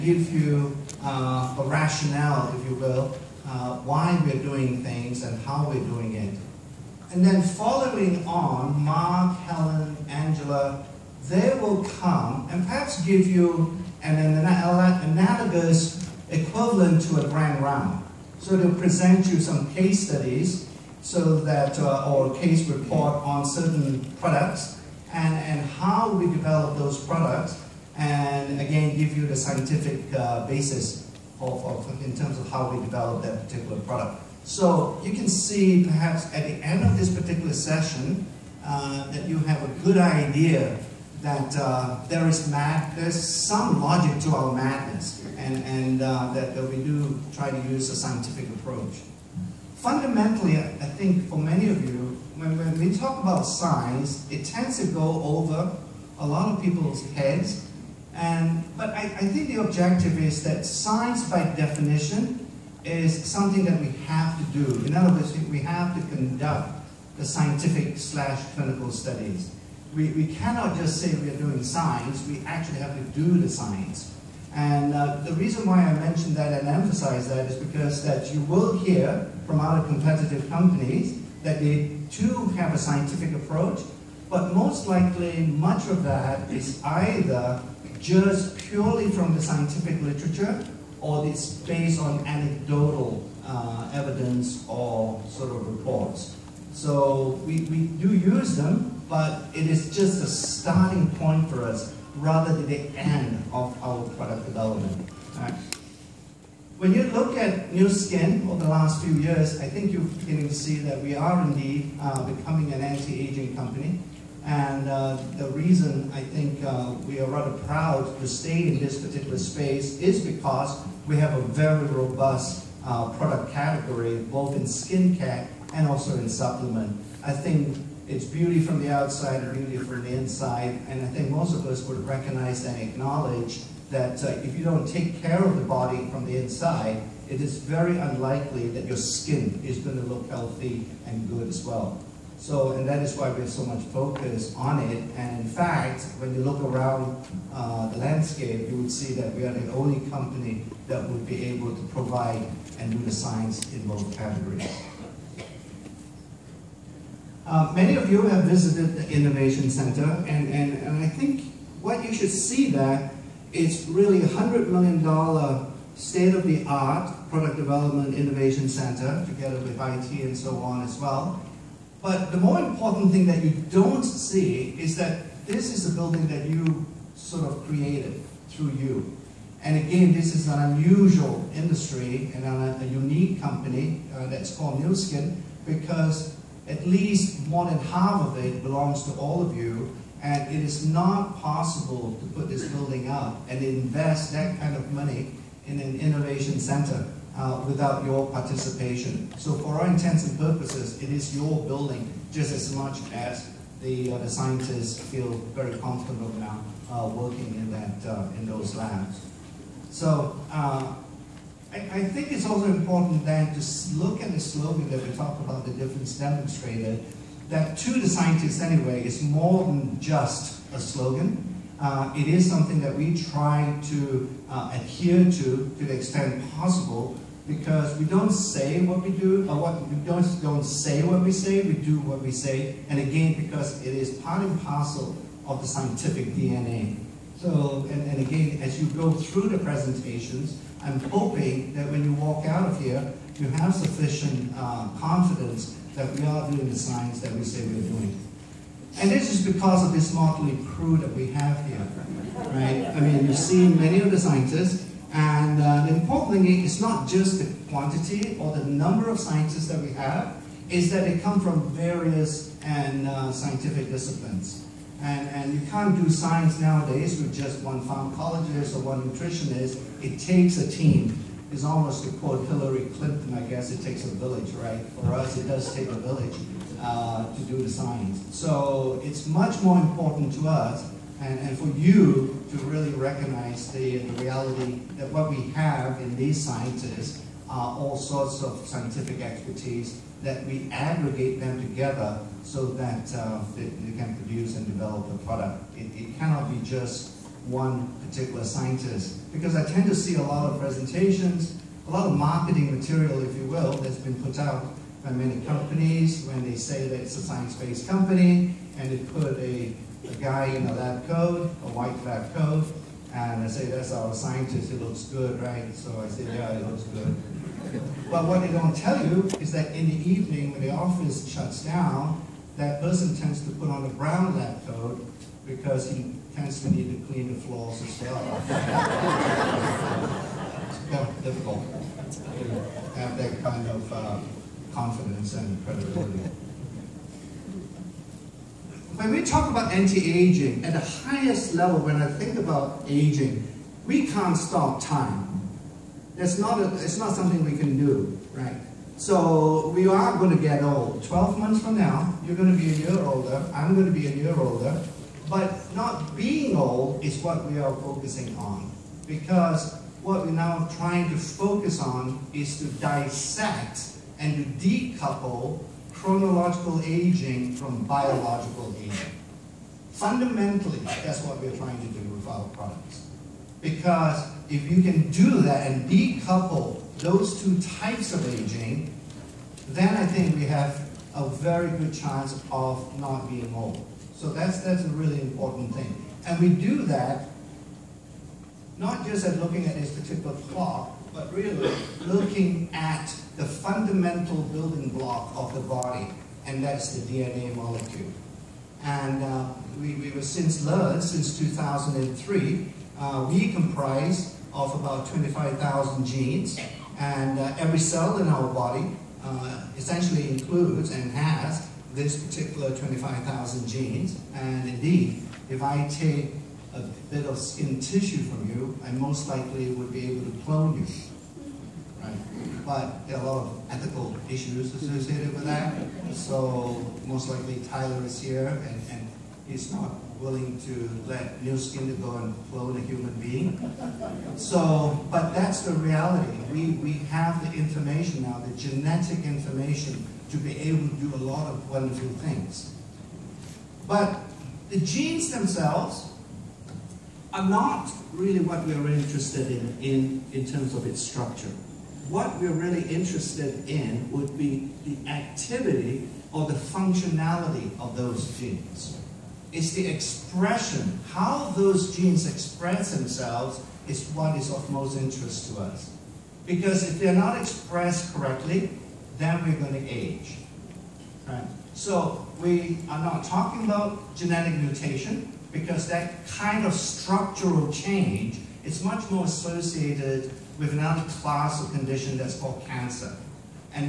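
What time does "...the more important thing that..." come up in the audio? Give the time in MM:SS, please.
02:52.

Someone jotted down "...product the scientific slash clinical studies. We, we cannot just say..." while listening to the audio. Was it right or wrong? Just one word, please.
wrong.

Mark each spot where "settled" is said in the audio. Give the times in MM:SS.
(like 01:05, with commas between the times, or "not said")
not said.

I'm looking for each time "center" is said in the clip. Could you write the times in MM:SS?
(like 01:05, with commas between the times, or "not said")
02:39, 02:48, 03:16.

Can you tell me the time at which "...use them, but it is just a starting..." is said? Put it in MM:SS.
01:38.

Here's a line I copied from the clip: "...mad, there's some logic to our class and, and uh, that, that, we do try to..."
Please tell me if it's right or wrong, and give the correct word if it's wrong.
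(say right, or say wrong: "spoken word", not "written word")
wrong: "madness", not "class".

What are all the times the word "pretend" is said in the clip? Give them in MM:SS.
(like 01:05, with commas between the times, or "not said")
not said.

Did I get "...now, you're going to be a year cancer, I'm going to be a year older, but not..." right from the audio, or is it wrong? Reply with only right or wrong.
wrong.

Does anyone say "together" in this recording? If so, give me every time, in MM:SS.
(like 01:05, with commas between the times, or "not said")
02:49, 04:51.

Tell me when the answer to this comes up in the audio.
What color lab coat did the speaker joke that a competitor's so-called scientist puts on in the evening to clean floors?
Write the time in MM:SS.
05:23.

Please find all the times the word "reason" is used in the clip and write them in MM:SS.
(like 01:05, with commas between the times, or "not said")
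01:15, 01:55.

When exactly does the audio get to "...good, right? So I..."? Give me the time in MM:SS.
05:15.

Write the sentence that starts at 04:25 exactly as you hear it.
And, and you can't do science nowadays with just one pharmacologist or one nutritionist.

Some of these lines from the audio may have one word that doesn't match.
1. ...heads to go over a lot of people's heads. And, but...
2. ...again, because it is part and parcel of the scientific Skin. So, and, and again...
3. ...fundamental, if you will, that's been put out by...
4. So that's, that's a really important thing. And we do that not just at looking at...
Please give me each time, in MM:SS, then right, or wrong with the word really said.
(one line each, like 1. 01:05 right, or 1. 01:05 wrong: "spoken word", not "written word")
1. 00:54 wrong: "tends", not "heads"
2. 03:52 wrong: "DNA", not "Skin"
3. 05:02 wrong: "material", not "fundamental"
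4. 06:24 right.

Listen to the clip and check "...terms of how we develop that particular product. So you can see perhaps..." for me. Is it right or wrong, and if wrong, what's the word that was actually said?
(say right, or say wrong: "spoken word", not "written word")
right.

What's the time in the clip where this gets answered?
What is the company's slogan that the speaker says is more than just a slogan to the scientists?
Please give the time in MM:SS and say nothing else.
03:35.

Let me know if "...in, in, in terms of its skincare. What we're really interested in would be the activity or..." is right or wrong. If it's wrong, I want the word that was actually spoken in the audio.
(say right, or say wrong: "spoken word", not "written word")
wrong: "structure", not "skincare".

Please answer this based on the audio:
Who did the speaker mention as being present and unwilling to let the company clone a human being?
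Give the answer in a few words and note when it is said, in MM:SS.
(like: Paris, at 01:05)
Tyler, at 07:07.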